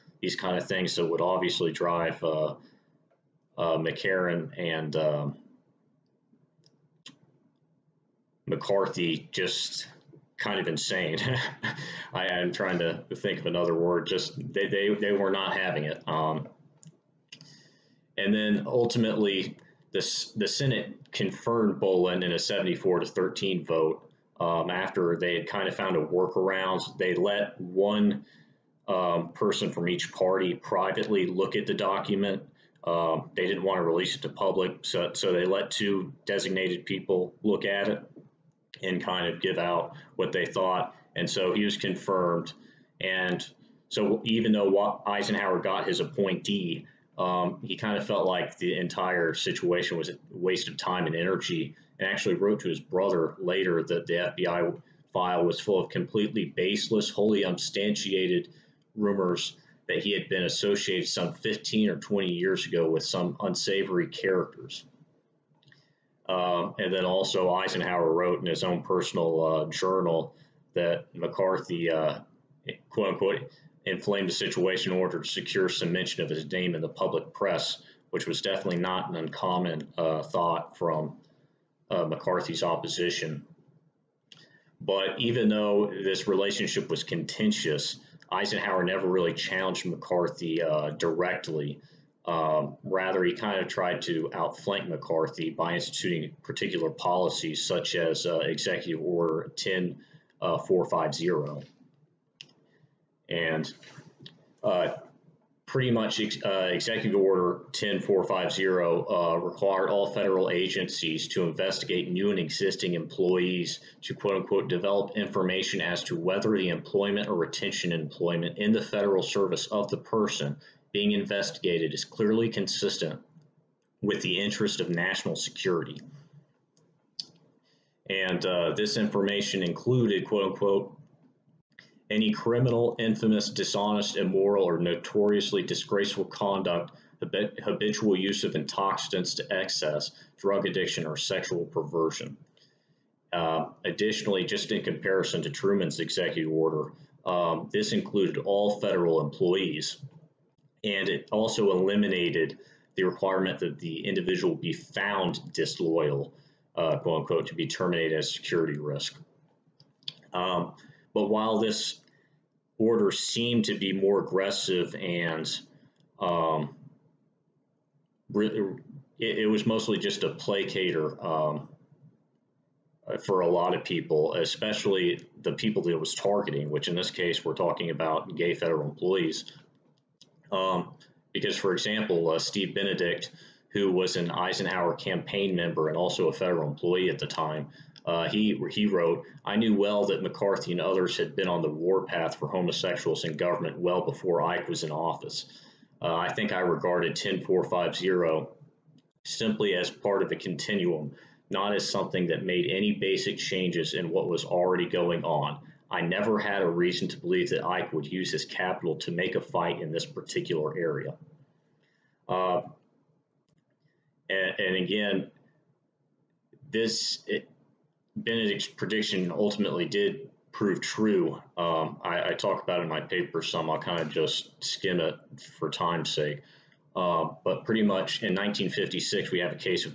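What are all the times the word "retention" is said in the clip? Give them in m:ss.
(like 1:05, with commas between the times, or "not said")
1:57.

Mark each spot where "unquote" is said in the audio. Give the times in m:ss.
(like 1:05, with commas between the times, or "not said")
1:13, 1:54, 2:10, 2:37.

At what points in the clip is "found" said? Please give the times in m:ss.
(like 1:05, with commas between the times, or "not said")
0:25, 2:34.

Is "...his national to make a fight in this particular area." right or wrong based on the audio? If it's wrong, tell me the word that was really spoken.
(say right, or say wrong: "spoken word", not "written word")
wrong: "capital", not "national".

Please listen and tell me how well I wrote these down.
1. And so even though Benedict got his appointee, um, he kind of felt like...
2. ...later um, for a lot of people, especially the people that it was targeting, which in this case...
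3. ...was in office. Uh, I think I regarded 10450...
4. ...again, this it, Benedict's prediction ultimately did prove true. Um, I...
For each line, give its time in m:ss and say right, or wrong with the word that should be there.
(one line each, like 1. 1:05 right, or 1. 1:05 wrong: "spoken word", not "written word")
1. 0:43 wrong: "Eisenhower", not "Benedict"
2. 2:50 wrong: "placater", not "later"
3. 3:14 right
4. 3:34 right.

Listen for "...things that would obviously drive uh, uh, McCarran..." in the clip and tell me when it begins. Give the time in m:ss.
0:00.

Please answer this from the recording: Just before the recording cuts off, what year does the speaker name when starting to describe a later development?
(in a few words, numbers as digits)
1956.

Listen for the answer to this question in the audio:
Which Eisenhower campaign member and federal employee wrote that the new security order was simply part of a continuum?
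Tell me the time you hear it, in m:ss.
3:02.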